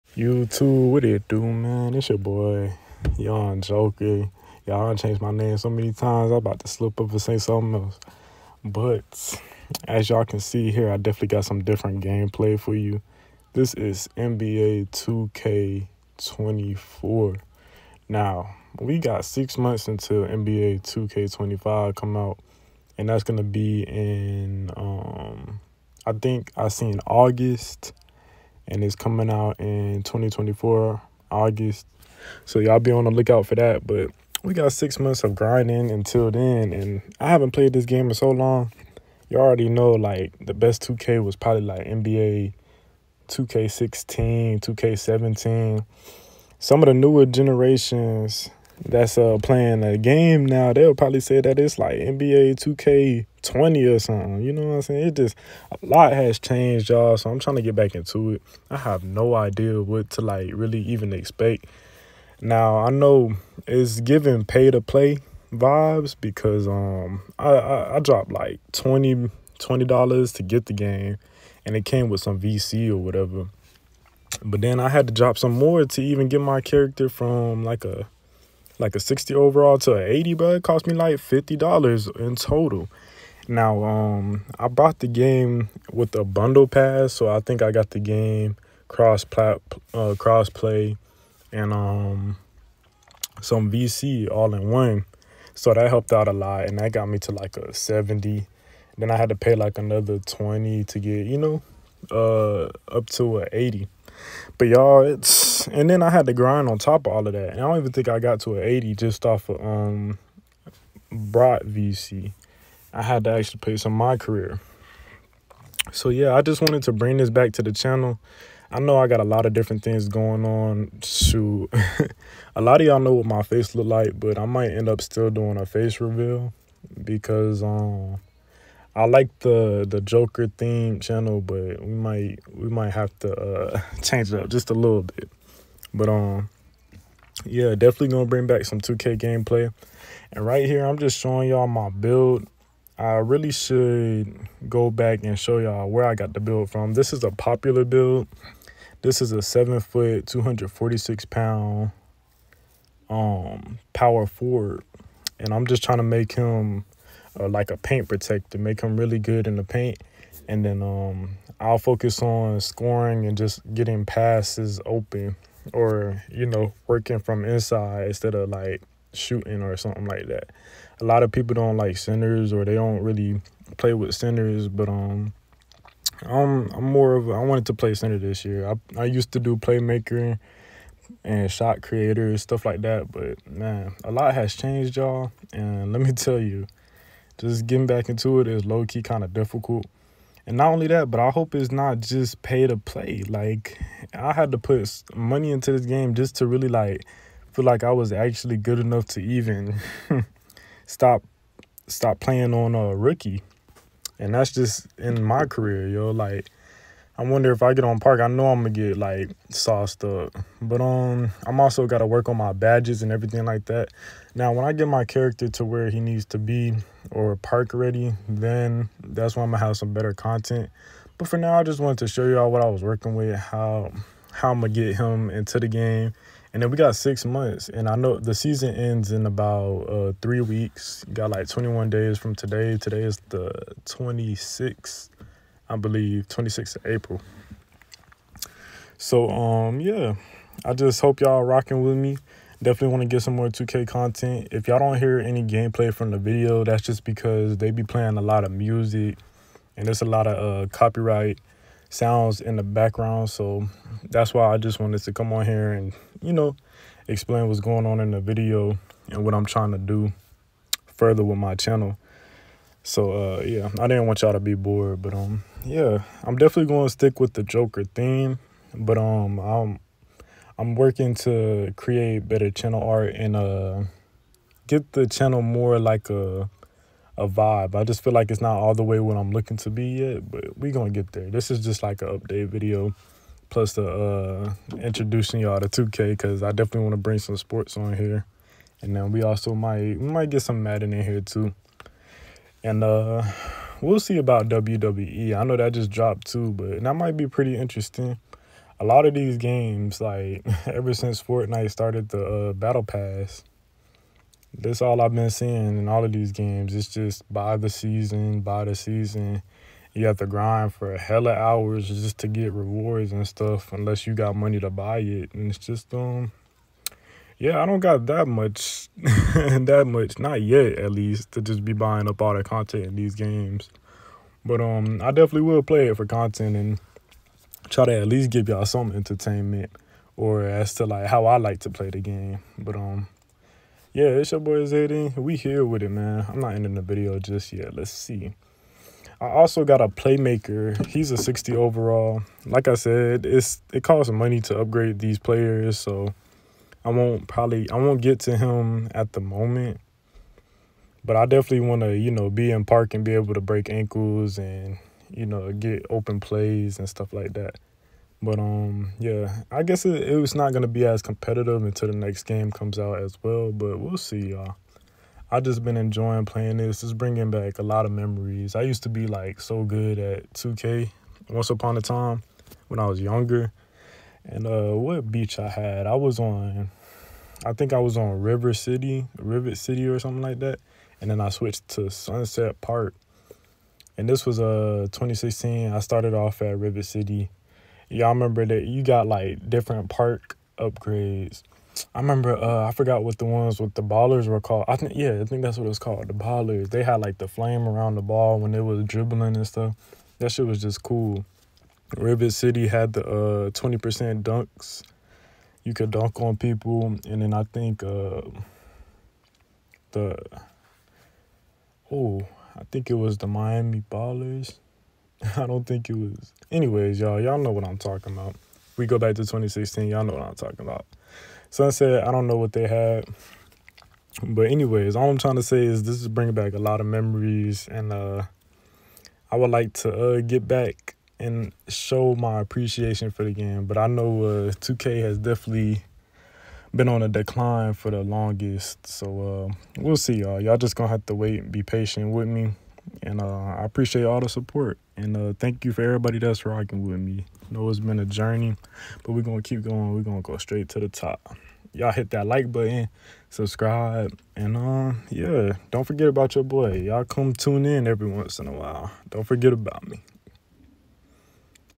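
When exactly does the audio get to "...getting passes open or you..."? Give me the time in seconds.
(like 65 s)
163 s.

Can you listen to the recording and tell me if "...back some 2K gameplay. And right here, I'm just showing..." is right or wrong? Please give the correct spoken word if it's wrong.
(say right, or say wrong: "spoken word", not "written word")
right.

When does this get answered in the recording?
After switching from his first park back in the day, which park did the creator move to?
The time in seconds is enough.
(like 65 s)
381 s.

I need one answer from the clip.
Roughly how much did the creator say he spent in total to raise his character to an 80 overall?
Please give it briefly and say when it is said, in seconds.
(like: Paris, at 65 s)
$50, at 81 s.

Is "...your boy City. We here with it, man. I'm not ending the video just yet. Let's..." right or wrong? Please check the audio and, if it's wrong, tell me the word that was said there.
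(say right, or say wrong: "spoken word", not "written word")
wrong: "Zayden", not "City".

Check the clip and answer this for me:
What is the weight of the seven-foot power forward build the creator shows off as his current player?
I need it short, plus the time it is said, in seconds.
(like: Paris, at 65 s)
246 pounds, at 150 s.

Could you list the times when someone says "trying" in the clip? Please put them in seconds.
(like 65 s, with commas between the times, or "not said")
57 s, 155 s, 259 s, 425 s.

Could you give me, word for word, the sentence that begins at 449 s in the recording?
We're gonna go straight to the top.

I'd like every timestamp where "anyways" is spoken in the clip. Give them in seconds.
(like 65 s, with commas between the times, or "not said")
416 s, 424 s.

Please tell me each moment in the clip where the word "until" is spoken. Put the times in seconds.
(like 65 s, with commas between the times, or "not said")
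19 s, 35 s, 361 s.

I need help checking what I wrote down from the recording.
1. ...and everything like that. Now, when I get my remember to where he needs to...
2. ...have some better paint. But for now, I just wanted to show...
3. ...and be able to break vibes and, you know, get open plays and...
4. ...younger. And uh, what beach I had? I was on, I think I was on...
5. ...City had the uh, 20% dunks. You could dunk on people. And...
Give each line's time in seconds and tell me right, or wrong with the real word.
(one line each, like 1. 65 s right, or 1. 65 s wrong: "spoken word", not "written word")
1. 213 s wrong: "character", not "remember"
2. 219 s wrong: "content", not "paint"
3. 352 s wrong: "ankles", not "vibes"
4. 373 s right
5. 402 s right.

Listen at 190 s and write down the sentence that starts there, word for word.
And not only that, but I hope it's not just pay to play.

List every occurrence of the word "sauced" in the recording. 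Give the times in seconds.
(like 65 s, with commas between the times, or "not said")
209 s.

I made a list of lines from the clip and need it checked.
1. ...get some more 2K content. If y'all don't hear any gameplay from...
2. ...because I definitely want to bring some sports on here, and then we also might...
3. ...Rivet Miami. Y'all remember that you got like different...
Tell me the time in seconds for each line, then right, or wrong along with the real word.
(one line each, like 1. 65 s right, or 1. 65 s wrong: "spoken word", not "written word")
1. 243 s right
2. 286 s right
3. 386 s wrong: "City", not "Miami".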